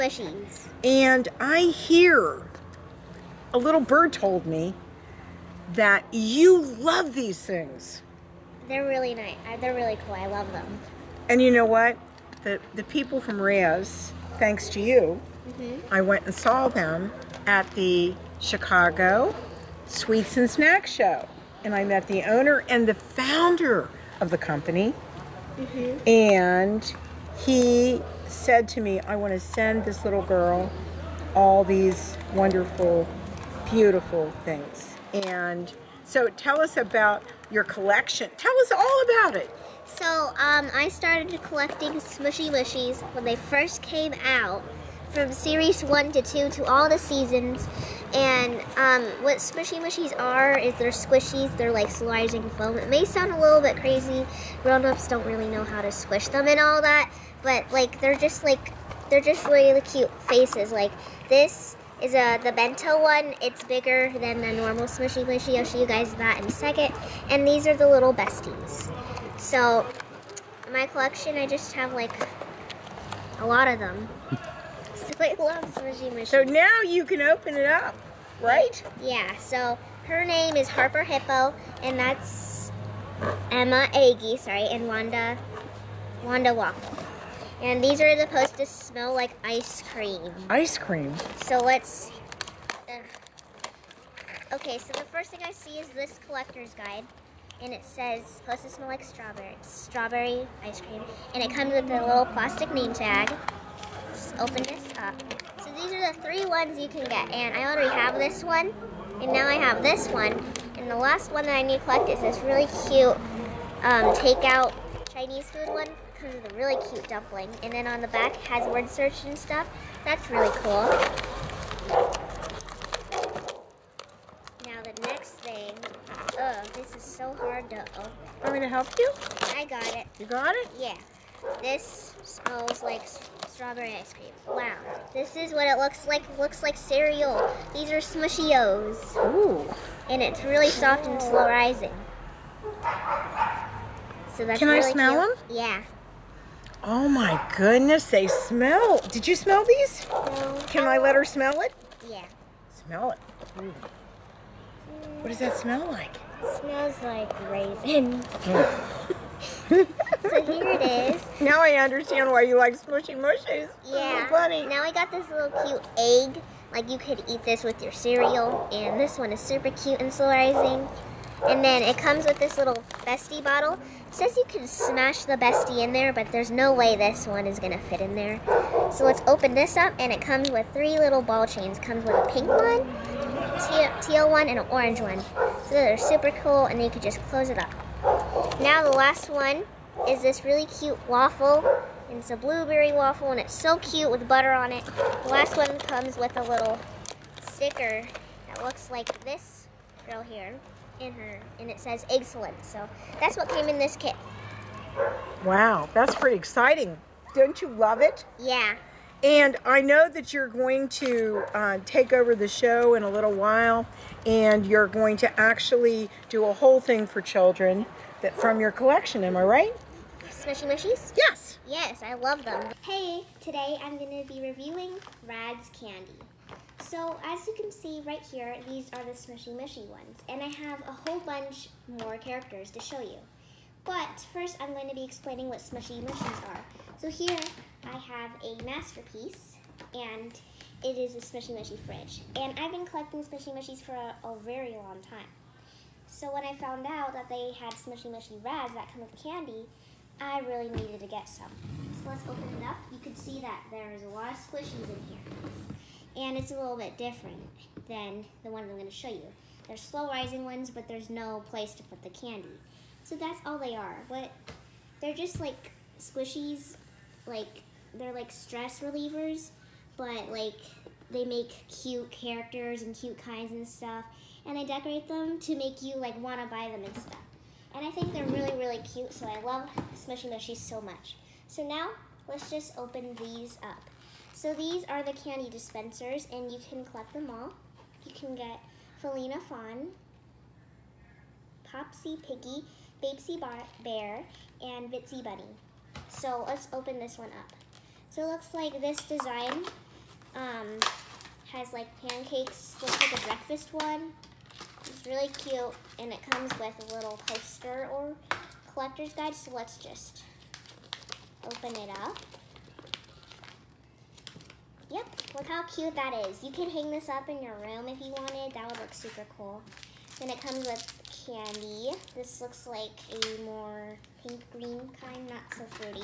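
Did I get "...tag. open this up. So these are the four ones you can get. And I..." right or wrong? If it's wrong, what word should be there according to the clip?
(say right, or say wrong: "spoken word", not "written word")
wrong: "three", not "four".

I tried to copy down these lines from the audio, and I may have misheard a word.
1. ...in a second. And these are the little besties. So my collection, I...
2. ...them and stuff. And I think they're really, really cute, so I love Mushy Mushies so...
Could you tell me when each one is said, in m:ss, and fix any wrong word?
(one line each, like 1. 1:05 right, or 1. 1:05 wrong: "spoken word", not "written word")
1. 1:06 right
2. 4:36 wrong: "Smushy", not "Mushy".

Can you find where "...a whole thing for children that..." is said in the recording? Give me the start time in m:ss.
3:36.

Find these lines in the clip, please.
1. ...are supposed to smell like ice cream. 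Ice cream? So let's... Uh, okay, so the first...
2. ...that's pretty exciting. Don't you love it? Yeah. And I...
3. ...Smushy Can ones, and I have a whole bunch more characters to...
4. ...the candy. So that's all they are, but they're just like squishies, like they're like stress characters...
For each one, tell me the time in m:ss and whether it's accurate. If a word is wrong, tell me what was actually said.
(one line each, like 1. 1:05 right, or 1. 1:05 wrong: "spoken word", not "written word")
1. 1:28 right
2. 3:25 right
3. 3:49 wrong: "Mushy", not "Can"
4. 4:22 wrong: "relievers", not "characters".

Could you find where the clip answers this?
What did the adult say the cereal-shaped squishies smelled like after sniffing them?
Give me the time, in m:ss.
2:37.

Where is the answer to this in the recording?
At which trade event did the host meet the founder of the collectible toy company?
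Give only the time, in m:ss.
0:18.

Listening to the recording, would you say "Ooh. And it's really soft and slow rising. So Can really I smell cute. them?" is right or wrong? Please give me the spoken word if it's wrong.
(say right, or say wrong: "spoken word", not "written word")
right.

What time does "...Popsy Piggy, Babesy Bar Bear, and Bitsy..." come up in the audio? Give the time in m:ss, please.
4:51.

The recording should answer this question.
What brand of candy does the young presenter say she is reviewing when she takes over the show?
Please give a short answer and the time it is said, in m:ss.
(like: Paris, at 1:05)
Radz Candy, at 3:45.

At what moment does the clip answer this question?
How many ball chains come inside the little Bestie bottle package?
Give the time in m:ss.
3:00.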